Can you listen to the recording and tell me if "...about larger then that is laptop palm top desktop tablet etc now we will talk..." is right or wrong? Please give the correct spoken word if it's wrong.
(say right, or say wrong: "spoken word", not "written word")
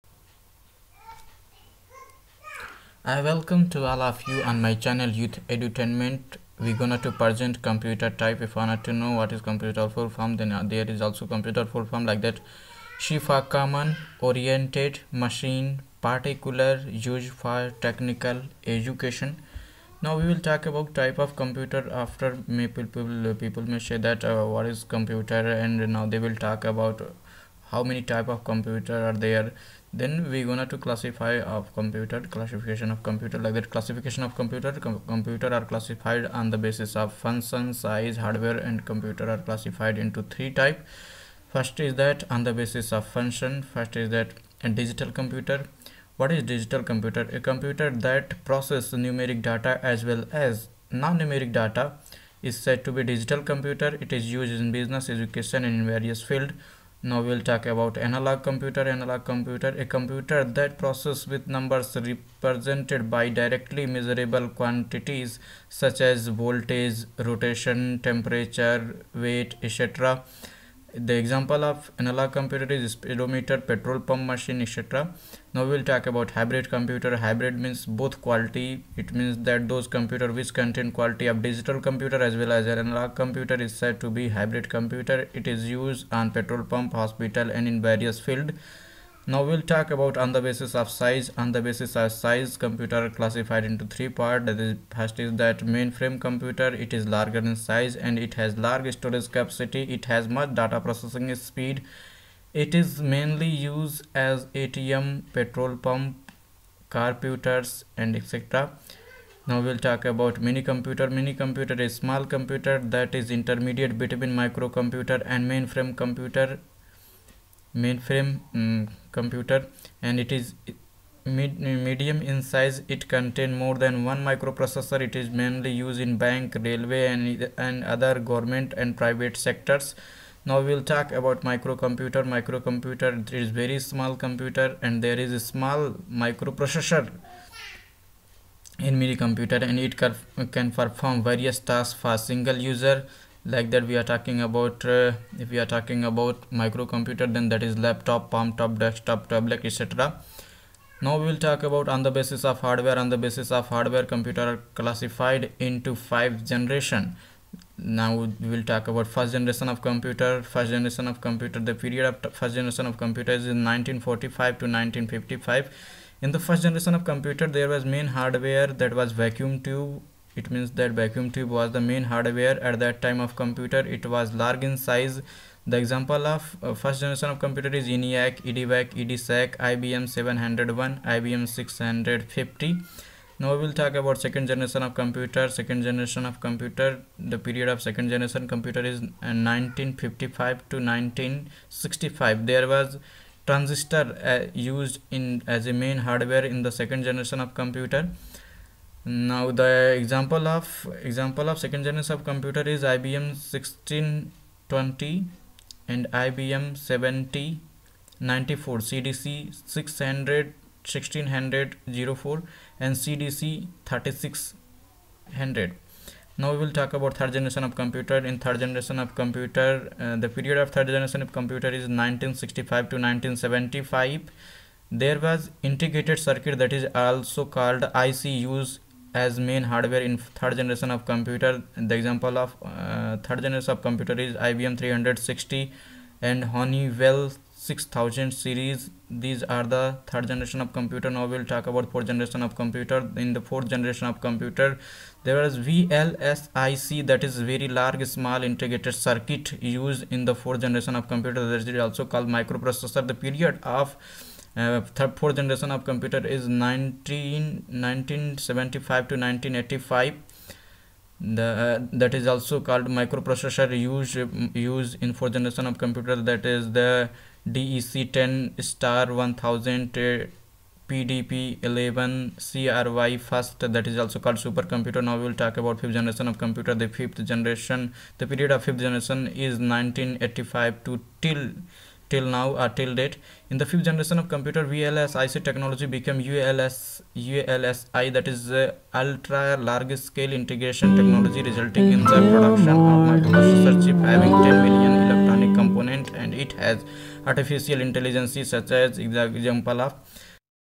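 wrong: "microcomputer", not "larger".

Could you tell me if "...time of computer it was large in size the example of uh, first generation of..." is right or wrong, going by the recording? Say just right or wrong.
right.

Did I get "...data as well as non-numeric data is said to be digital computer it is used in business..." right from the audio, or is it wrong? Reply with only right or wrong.
right.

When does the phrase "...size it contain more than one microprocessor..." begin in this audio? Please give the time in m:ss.
2:02.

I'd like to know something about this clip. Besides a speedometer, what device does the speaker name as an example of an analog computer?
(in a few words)
Petrol pump machine.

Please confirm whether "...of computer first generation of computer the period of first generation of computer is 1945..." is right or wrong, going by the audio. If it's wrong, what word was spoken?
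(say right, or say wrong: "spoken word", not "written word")
right.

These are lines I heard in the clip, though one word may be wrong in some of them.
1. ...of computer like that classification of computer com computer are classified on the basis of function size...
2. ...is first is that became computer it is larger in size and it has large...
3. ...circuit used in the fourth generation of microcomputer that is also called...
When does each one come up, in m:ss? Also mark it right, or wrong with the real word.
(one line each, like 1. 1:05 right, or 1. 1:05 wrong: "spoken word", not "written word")
1. 0:32 right
2. 1:34 wrong: "mainframe", not "became"
3. 4:08 wrong: "computer", not "microcomputer".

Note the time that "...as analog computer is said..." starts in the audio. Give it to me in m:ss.
1:22.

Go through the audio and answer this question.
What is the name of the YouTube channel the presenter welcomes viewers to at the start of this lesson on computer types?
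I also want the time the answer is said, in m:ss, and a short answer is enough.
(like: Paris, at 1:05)
Youth Edutainment, at 0:05.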